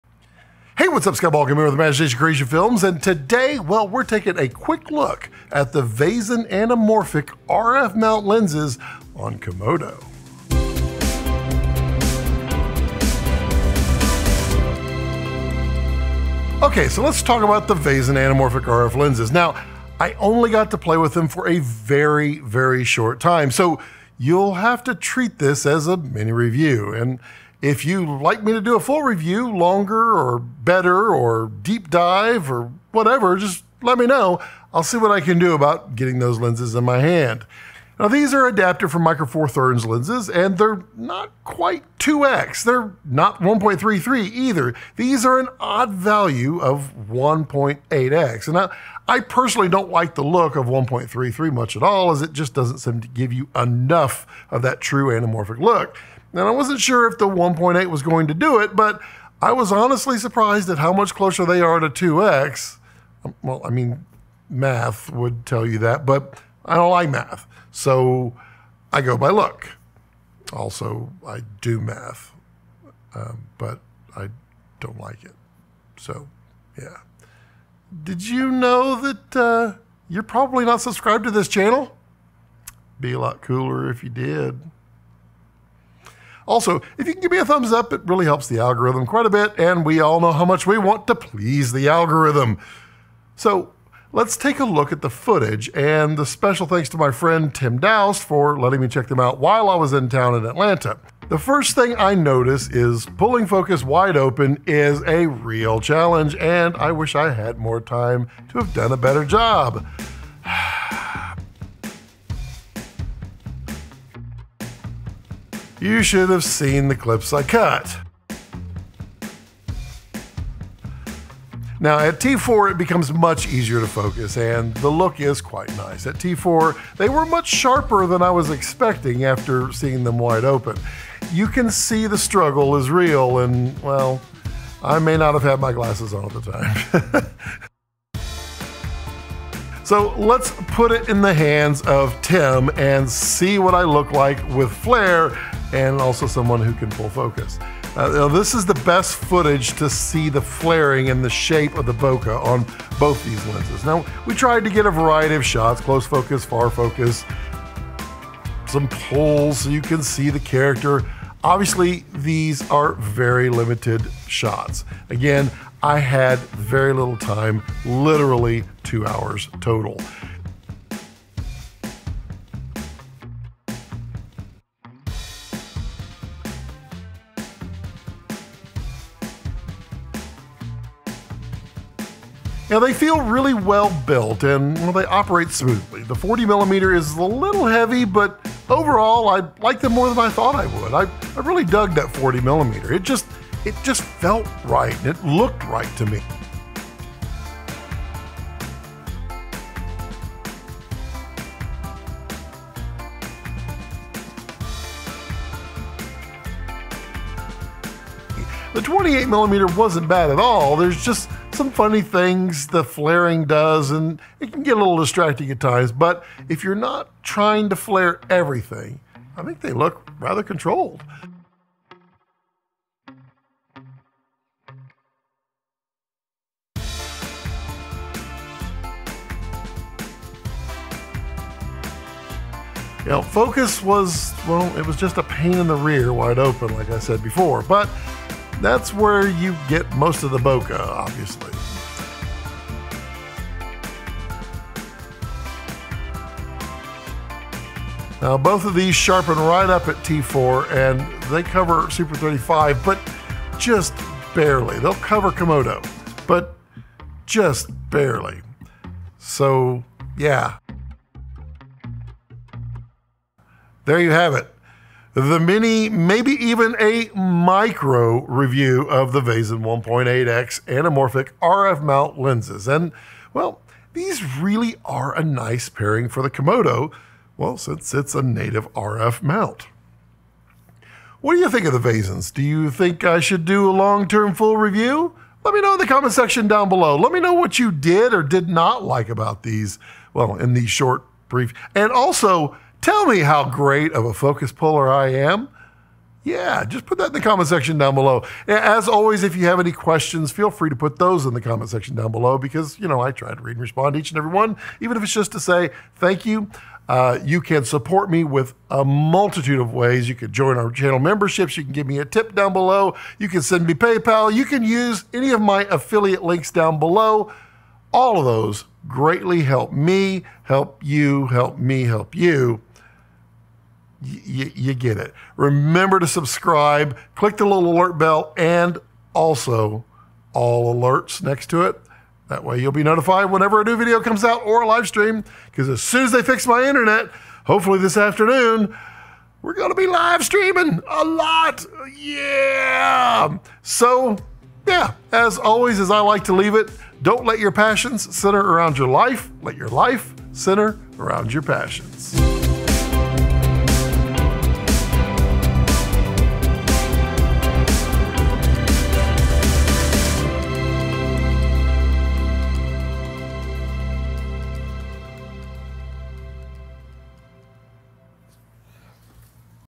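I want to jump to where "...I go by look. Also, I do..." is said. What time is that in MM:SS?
01:08.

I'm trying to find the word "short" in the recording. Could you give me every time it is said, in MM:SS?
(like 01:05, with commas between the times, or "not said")
00:22, 04:50.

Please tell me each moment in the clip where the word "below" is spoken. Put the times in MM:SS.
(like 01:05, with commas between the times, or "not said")
04:46, 04:57, 05:02, 05:12, 05:16.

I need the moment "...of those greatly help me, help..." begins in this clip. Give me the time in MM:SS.
05:18.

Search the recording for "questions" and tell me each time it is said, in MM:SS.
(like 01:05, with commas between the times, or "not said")
04:59.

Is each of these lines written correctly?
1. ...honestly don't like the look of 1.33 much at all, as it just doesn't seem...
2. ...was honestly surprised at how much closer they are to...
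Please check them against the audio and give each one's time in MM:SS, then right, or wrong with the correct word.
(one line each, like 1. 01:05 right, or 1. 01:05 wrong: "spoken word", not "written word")
1. 00:49 wrong: "personally", not "honestly"
2. 00:59 right.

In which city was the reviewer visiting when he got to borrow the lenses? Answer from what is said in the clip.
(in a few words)
Atlanta.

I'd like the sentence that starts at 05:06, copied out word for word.
Uh, you can support me with a multitude of ways.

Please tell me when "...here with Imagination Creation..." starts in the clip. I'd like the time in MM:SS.
00:01.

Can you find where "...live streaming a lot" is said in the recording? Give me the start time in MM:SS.
05:39.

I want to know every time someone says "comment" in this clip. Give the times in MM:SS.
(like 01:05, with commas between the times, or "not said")
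04:45, 04:57, 05:01.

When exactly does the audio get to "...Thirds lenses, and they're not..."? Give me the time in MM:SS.
00:39.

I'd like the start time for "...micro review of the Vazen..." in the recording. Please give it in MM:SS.
04:27.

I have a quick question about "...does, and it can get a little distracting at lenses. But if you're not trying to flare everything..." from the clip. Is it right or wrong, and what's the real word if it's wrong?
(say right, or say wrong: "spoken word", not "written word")
wrong: "times", not "lenses".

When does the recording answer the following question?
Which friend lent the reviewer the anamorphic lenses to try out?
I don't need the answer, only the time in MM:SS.
01:37.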